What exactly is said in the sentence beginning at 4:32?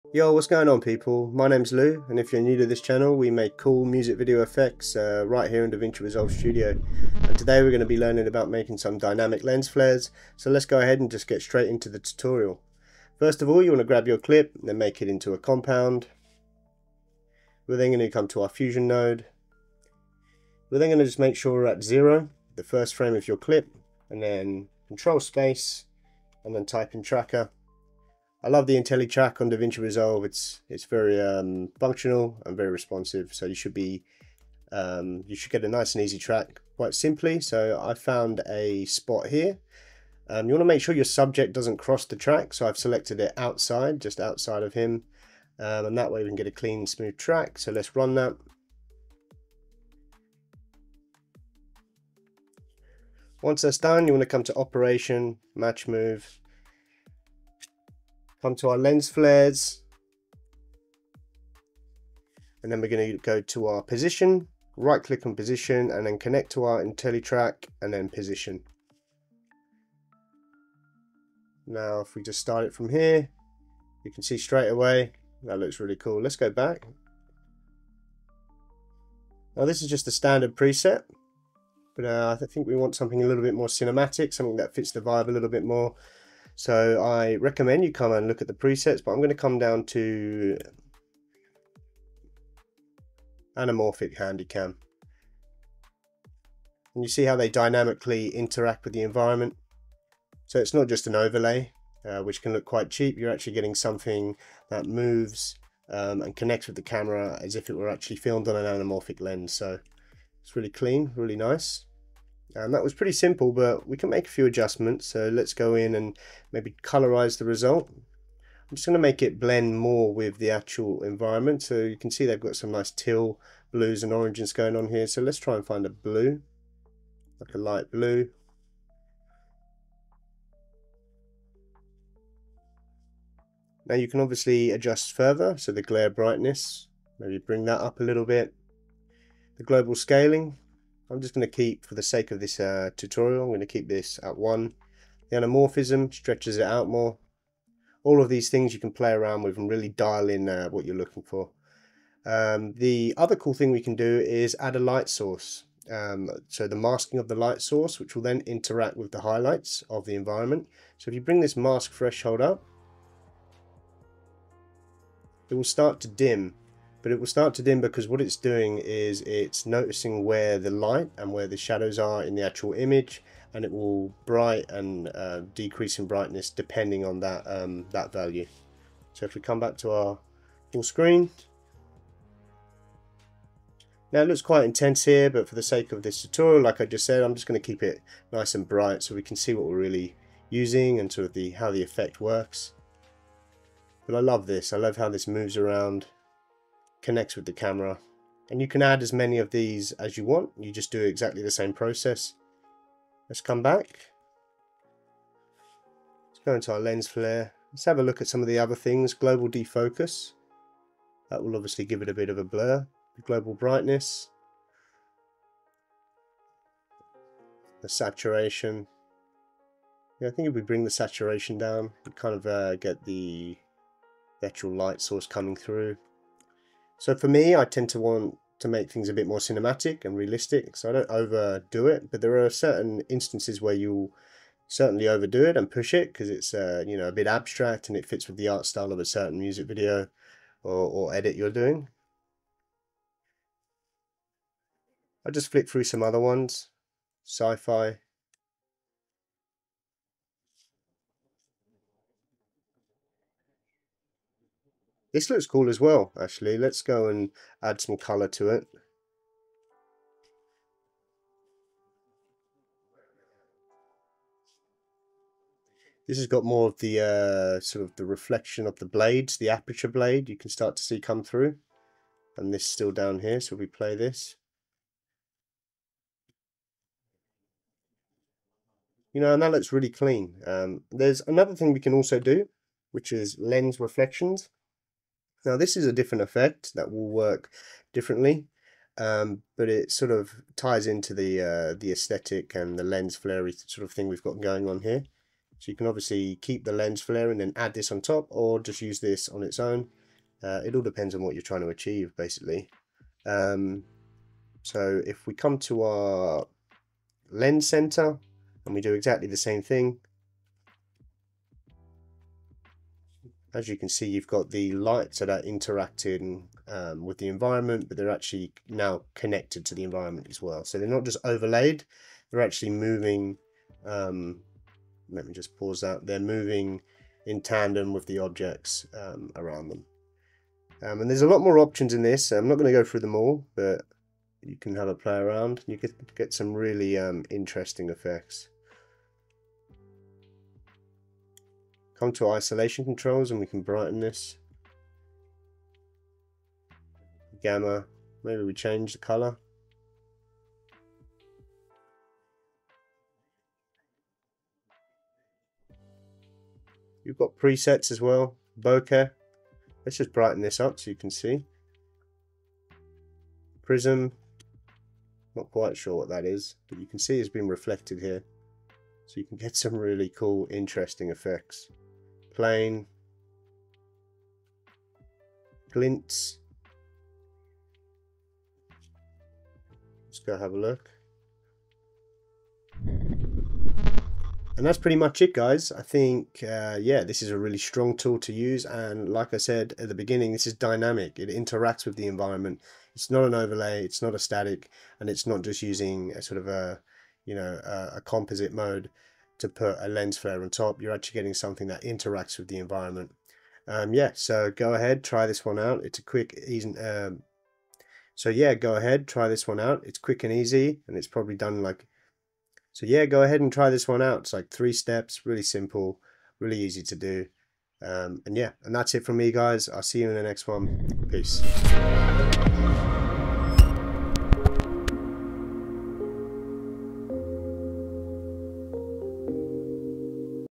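And this still down here, so we play this.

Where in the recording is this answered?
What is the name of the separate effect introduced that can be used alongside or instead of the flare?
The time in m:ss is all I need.
4:43.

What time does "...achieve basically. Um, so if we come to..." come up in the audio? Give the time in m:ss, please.
5:01.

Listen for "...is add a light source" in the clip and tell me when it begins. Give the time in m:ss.
2:34.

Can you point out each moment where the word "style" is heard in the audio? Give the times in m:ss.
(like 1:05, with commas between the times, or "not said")
3:58.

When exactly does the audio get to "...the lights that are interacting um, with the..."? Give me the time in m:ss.
5:14.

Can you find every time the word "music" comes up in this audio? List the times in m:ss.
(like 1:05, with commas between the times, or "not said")
0:03, 3:59.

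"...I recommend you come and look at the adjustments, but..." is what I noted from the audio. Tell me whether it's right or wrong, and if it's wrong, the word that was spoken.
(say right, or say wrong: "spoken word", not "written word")
wrong: "presets", not "adjustments".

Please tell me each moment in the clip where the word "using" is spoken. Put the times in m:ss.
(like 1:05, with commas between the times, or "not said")
3:10, 6:35.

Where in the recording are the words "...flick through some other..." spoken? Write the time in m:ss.
4:05.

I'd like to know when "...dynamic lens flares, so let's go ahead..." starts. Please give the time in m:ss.
0:08.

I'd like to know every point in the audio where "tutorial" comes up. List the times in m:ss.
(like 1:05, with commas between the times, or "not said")
0:11, 2:22, 3:06.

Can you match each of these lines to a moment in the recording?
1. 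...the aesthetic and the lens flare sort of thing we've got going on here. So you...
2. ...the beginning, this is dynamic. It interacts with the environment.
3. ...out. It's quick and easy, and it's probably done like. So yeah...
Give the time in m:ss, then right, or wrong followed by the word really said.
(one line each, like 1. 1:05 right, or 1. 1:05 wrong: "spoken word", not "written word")
1. 4:51 right
2. 6:29 right
3. 6:49 right.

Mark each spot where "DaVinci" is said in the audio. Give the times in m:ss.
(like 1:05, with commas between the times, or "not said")
0:05, 0:29.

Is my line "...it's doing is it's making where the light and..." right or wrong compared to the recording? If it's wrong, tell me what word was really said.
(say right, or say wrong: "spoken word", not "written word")
wrong: "noticing", not "making".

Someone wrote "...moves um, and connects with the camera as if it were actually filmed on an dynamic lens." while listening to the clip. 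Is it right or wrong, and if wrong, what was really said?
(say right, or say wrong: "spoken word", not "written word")
wrong: "anamorphic", not "dynamic".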